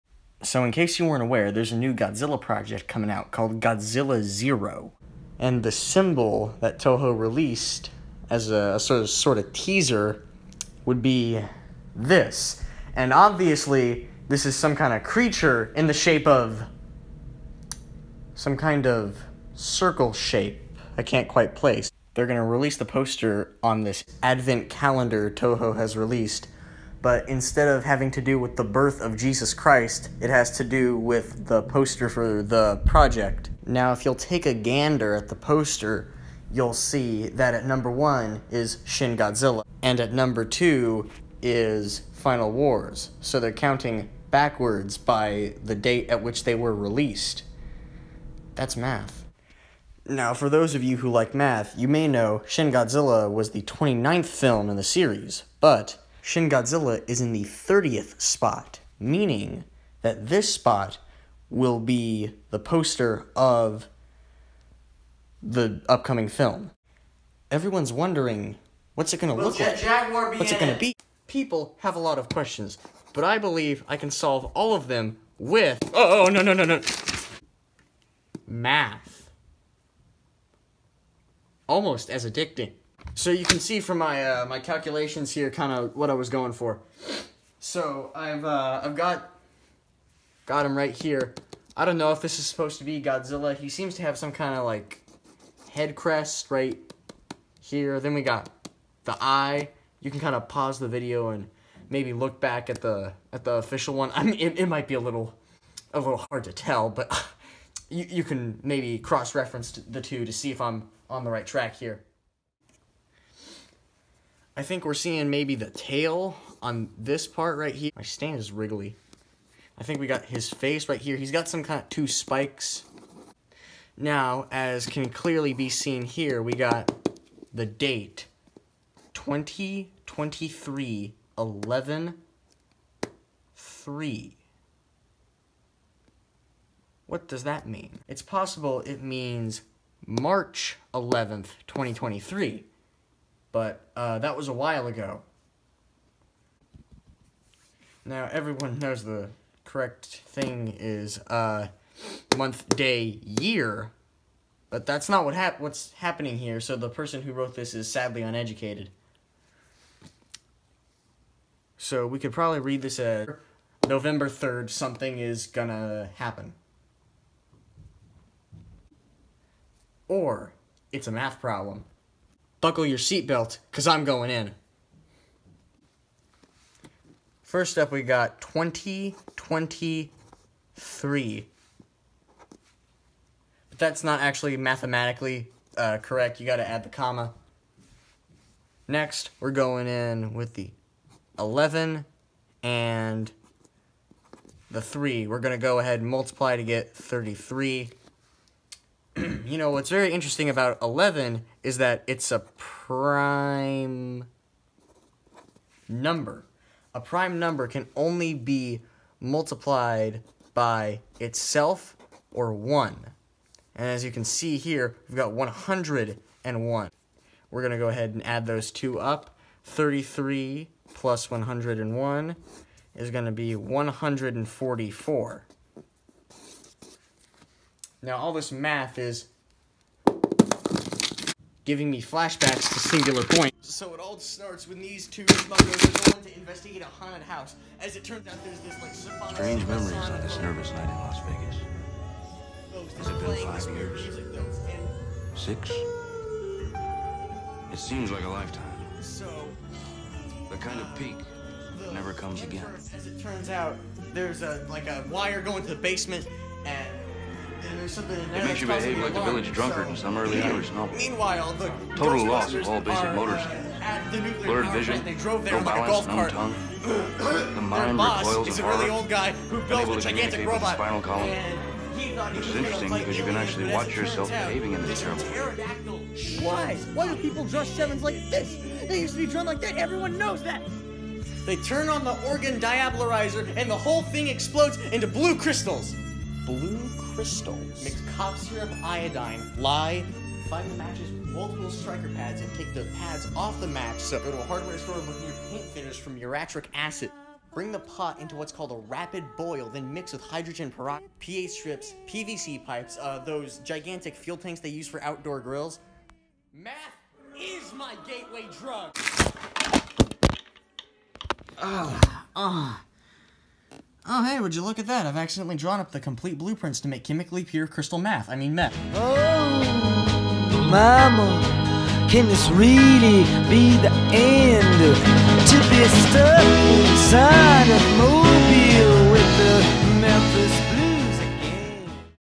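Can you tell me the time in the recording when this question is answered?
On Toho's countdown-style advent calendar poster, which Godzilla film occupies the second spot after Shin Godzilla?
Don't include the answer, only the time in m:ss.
0:42.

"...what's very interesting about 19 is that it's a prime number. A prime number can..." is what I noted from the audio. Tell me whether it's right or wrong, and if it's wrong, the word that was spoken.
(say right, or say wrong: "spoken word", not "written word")
wrong: "11", not "19".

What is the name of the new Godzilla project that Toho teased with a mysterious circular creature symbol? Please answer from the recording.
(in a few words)
Godzilla Zero.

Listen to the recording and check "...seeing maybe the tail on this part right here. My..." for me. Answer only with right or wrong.
right.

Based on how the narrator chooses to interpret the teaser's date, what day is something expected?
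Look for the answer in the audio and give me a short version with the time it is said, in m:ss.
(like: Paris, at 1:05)
November 3rd, at 2:43.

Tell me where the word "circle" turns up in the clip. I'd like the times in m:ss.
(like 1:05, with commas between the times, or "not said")
0:19.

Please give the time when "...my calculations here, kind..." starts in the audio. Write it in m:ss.
1:24.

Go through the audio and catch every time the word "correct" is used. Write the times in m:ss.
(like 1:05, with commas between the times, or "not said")
2:29, 3:05.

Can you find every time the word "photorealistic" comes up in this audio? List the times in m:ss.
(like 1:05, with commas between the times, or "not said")
not said.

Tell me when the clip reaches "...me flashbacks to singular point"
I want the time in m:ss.
3:51.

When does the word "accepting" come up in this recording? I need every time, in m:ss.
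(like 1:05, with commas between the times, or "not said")
not said.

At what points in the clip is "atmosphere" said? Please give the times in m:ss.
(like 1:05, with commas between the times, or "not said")
not said.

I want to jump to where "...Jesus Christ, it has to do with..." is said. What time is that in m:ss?
0:29.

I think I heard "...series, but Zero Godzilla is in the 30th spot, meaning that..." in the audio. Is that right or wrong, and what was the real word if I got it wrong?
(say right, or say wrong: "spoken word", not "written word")
wrong: "Shin", not "Zero".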